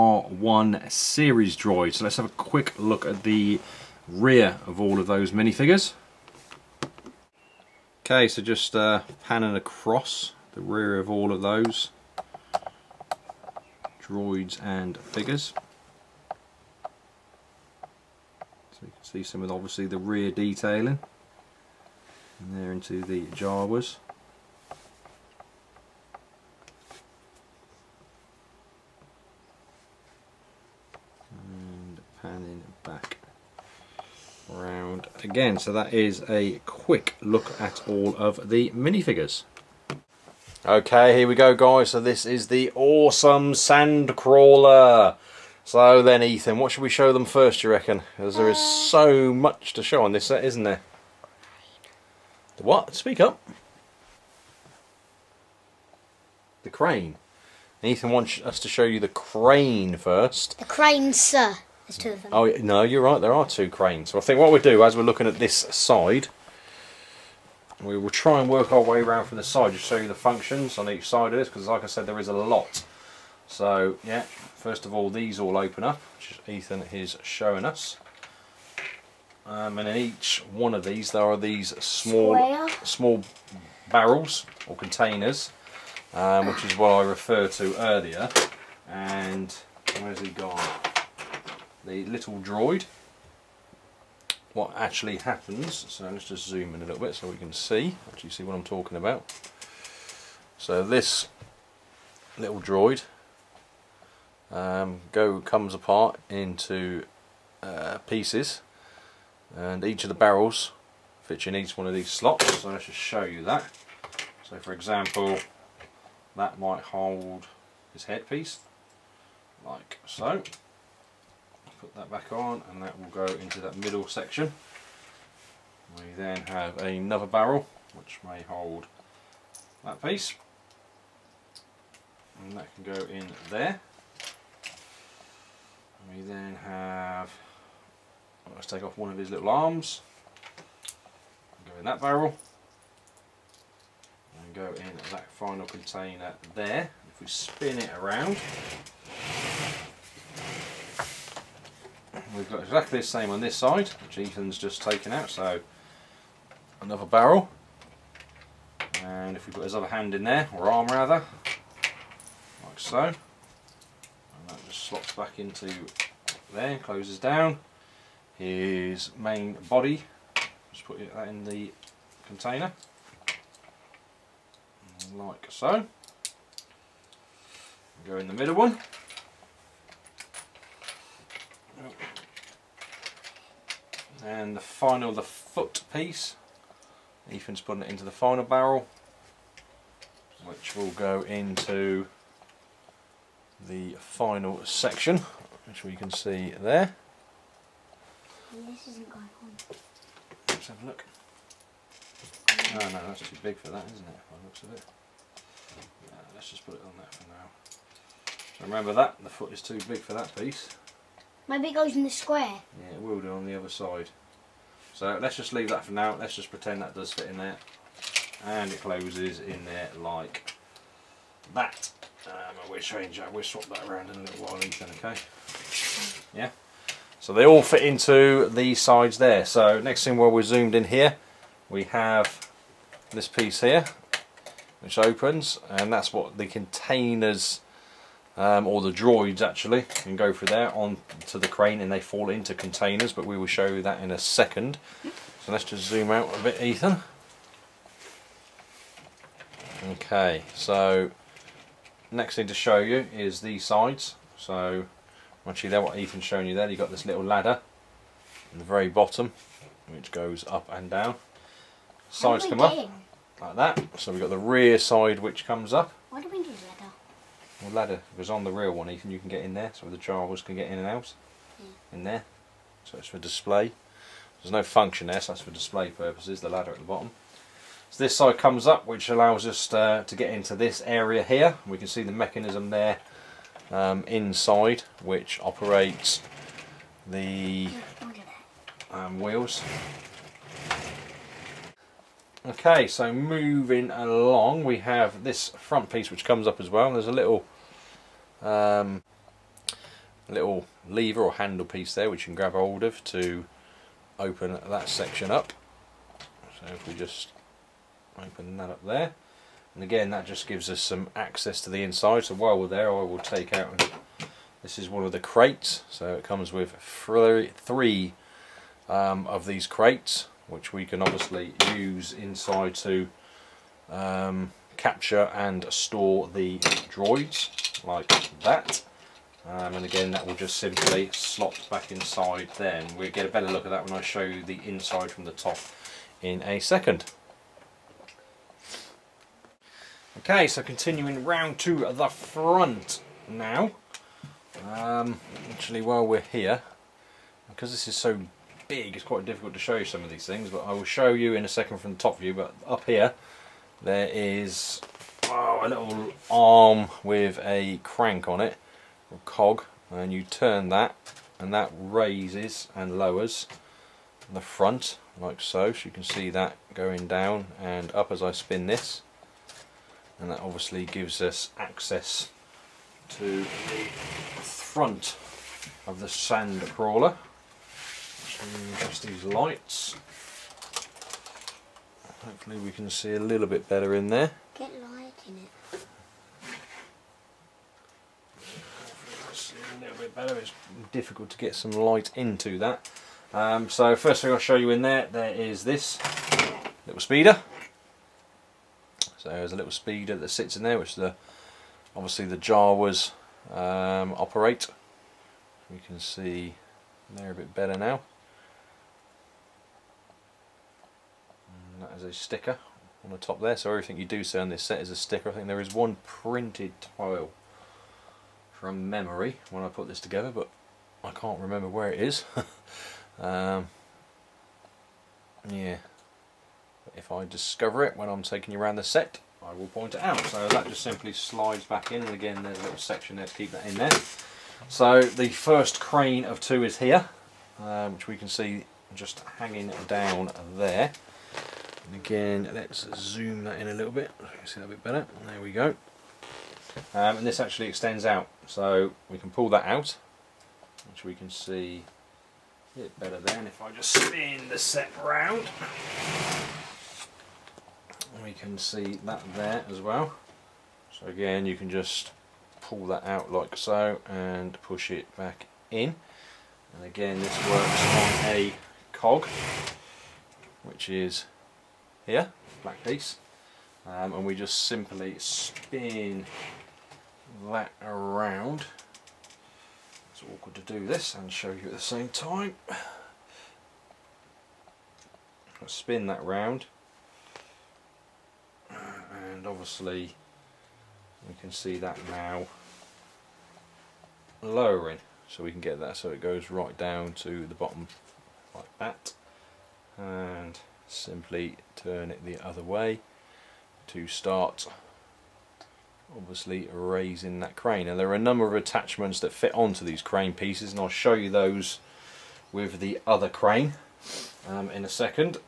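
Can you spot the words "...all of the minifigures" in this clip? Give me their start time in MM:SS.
00:37.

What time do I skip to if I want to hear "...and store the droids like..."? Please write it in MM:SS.
05:25.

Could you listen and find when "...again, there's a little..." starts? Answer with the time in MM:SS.
07:12.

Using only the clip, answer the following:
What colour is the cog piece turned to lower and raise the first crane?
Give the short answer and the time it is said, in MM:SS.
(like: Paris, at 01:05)
Black, at 07:52.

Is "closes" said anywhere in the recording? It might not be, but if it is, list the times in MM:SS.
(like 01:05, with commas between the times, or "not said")
02:46, 03:38.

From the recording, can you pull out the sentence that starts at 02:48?
His main body, just put that in the container, like so.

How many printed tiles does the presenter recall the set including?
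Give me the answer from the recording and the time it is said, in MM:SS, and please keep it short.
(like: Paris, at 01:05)
1, at 06:55.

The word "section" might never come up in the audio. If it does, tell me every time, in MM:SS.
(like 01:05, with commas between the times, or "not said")
02:04, 03:14, 05:04, 07:12.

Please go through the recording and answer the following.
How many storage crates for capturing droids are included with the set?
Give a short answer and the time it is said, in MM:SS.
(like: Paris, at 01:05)
3, at 05:16.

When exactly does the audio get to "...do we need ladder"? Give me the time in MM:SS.
04:26.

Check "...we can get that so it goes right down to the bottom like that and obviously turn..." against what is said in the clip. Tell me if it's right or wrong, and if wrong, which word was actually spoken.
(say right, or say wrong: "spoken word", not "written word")
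wrong: "simply", not "obviously".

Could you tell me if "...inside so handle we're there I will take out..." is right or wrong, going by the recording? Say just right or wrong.
wrong.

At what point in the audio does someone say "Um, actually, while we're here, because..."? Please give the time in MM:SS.
05:44.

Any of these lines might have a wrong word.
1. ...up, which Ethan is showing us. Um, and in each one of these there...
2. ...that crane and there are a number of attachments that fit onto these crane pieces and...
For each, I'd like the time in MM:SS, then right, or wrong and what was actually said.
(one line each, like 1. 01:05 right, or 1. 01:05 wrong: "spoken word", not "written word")
1. 01:15 right
2. 08:27 right.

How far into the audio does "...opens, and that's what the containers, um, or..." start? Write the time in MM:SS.
03:54.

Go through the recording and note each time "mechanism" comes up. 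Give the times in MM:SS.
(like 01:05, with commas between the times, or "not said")
04:42.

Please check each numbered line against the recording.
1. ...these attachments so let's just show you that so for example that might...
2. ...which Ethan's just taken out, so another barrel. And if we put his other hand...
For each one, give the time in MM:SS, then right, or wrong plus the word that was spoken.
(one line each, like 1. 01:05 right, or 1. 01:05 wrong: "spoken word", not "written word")
1. 01:51 wrong: "slots", not "attachments"
2. 02:33 right.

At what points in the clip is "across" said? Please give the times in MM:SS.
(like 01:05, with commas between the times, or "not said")
00:09.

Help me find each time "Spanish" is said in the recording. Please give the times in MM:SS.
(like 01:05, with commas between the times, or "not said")
not said.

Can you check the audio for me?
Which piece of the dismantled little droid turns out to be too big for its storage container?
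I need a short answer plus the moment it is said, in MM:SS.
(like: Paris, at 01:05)
The foot piece, at 03:05.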